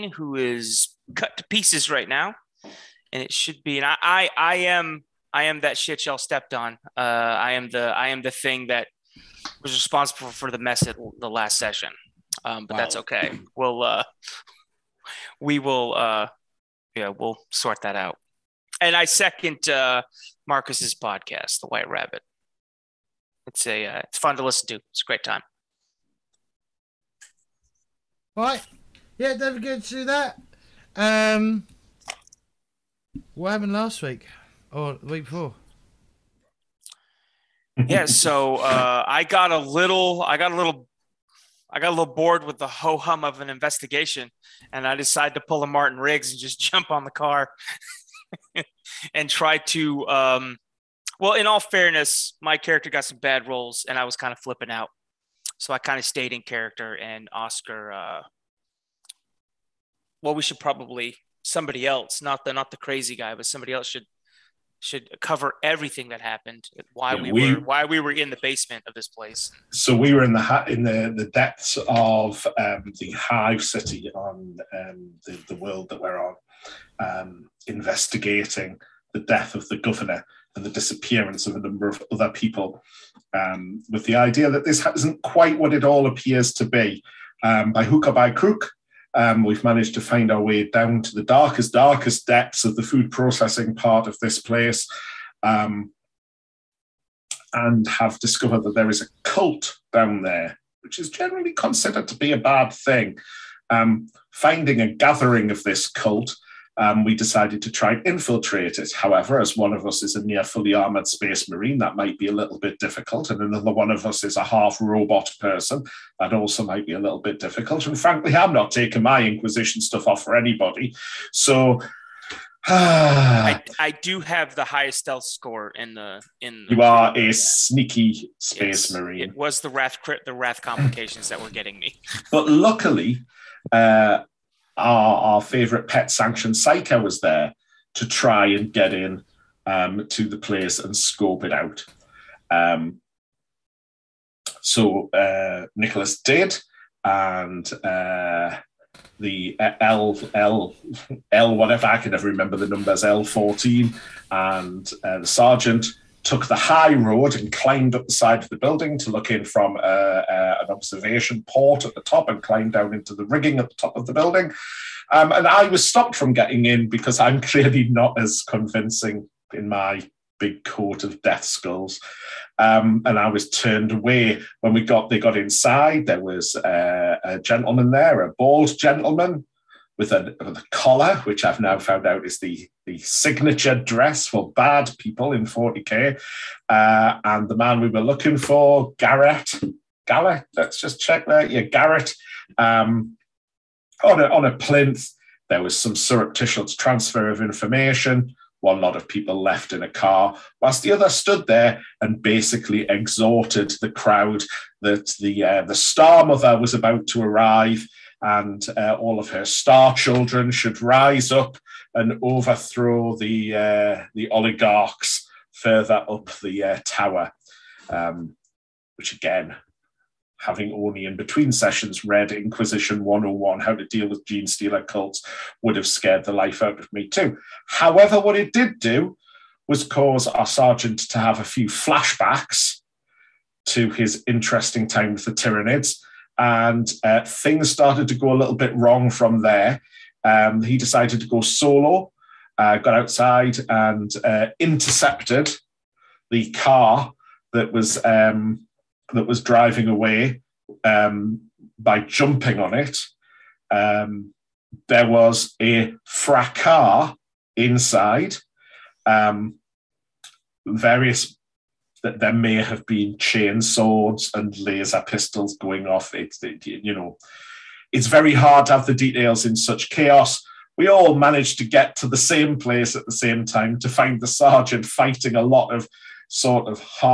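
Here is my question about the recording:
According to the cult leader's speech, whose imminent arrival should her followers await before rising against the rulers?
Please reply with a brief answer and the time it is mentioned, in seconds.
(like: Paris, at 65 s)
The Star Mother, at 205 s.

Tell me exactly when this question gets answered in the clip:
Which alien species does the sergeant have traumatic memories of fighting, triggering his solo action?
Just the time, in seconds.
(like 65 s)
235 s.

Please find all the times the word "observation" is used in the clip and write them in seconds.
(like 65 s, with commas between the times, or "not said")
160 s.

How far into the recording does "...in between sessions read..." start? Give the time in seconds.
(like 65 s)
221 s.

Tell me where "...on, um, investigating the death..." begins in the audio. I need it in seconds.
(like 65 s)
76 s.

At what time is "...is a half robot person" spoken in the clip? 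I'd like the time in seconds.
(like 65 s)
114 s.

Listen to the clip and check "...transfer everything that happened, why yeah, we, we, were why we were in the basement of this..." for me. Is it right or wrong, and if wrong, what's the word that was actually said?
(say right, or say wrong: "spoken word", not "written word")
wrong: "cover", not "transfer".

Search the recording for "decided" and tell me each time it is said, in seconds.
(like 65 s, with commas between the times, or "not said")
44 s, 107 s, 240 s.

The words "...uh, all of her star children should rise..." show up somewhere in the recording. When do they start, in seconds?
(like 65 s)
208 s.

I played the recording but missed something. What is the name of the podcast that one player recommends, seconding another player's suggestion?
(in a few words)
The White Rabbit.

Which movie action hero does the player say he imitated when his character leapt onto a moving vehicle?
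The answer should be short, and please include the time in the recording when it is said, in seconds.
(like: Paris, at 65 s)
Martin Riggs, at 45 s.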